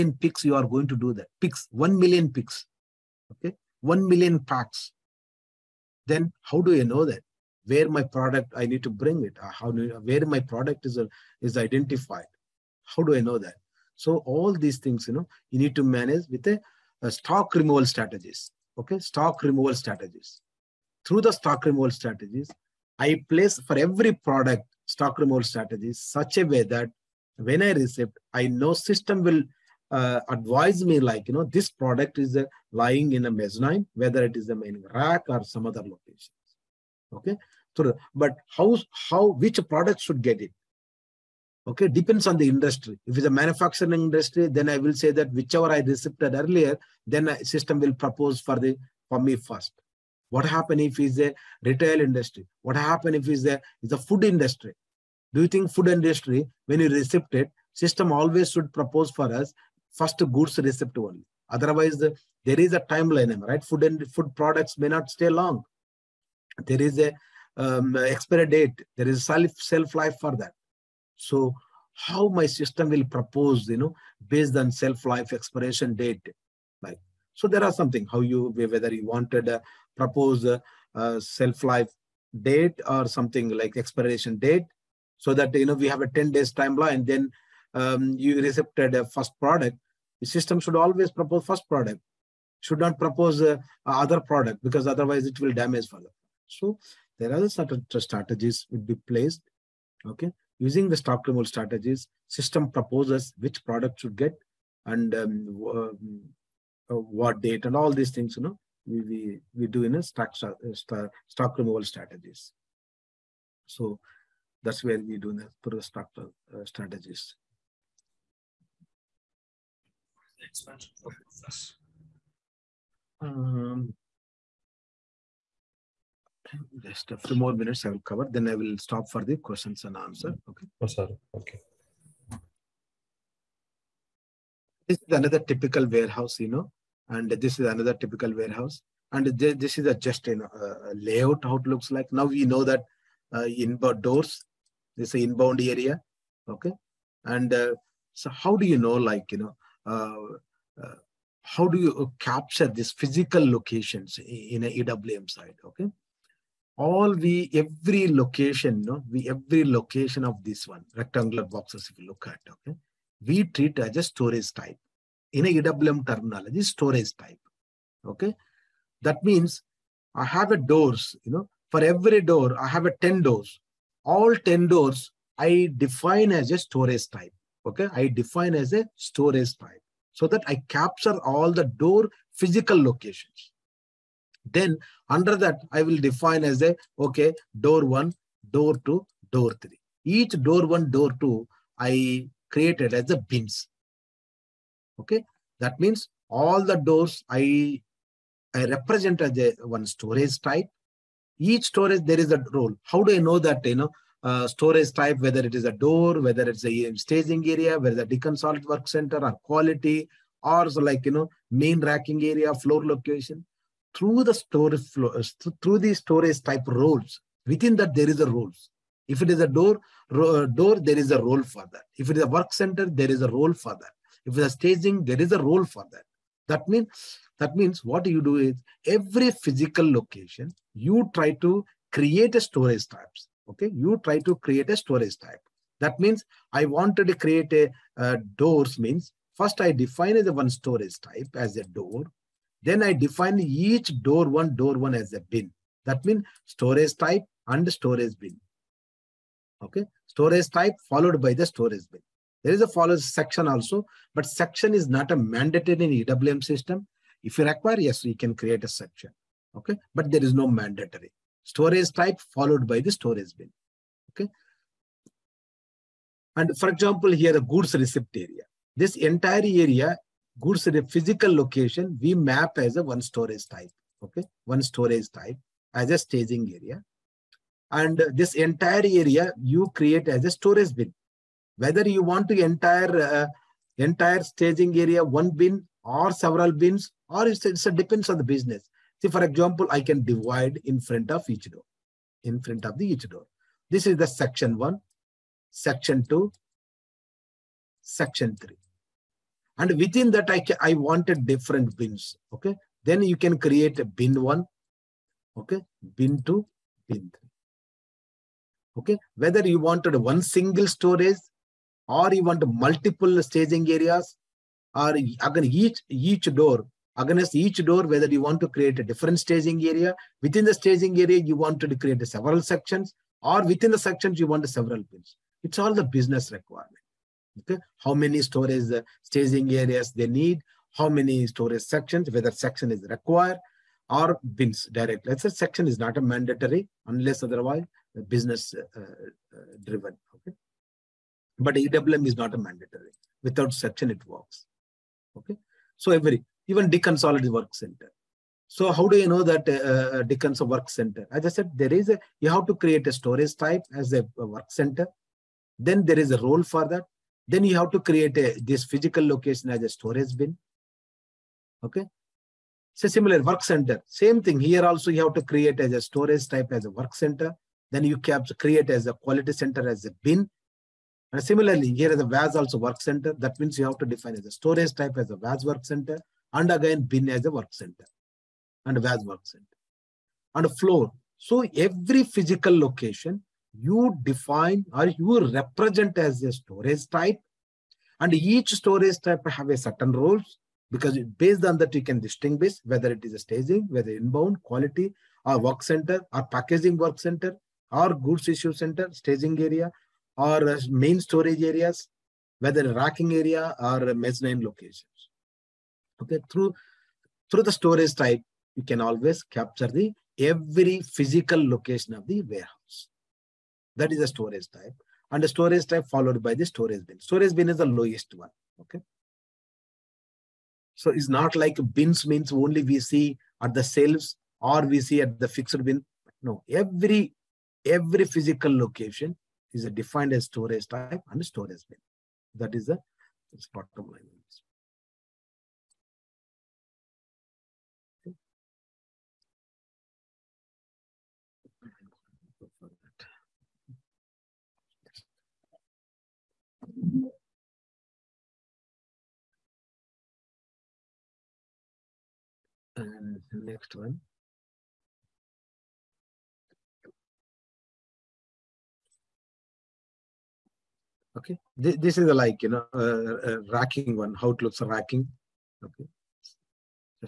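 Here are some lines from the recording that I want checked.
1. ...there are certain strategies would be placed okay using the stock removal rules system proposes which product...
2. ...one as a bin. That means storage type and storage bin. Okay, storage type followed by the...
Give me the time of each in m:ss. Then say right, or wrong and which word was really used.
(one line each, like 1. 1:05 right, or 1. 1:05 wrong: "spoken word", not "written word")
1. 1:37 wrong: "strategies", not "rules"
2. 4:04 right.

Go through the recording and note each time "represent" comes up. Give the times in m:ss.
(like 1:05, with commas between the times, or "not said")
3:18, 6:25.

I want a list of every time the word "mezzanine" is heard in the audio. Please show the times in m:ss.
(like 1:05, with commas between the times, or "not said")
0:33, 6:43.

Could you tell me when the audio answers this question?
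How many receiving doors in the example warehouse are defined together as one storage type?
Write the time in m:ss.
2:54.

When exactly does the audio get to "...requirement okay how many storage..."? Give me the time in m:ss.
5:26.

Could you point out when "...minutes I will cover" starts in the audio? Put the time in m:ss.
2:07.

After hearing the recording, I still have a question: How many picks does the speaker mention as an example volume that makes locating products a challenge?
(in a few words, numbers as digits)
1 million.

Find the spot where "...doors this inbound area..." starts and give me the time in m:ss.
2:24.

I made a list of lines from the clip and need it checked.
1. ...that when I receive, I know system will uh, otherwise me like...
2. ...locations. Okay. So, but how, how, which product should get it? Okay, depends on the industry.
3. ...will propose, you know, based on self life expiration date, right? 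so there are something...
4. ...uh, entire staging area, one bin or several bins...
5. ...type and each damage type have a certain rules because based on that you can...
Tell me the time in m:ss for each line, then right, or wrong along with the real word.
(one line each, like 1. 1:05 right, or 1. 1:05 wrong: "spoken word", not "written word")
1. 0:26 wrong: "advise", not "otherwise"
2. 0:35 right
3. 1:12 right
4. 4:42 right
5. 6:26 wrong: "storage", not "damage".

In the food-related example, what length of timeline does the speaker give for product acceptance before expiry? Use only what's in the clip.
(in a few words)
10 days.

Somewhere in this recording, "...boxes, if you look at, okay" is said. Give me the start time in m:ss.
2:41.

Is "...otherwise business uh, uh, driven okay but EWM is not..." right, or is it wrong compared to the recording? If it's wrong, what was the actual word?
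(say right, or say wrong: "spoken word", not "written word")
right.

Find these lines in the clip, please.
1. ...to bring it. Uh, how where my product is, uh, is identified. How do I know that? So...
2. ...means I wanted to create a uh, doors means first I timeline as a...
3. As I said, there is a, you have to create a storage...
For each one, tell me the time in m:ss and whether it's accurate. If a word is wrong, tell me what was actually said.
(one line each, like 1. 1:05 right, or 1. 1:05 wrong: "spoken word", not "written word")
1. 0:08 right
2. 3:55 wrong: "define", not "timeline"
3. 5:51 right.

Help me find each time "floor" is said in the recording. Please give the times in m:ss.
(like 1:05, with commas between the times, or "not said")
3:32, 6:20.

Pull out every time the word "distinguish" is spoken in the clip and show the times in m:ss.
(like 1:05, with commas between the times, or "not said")
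6:32.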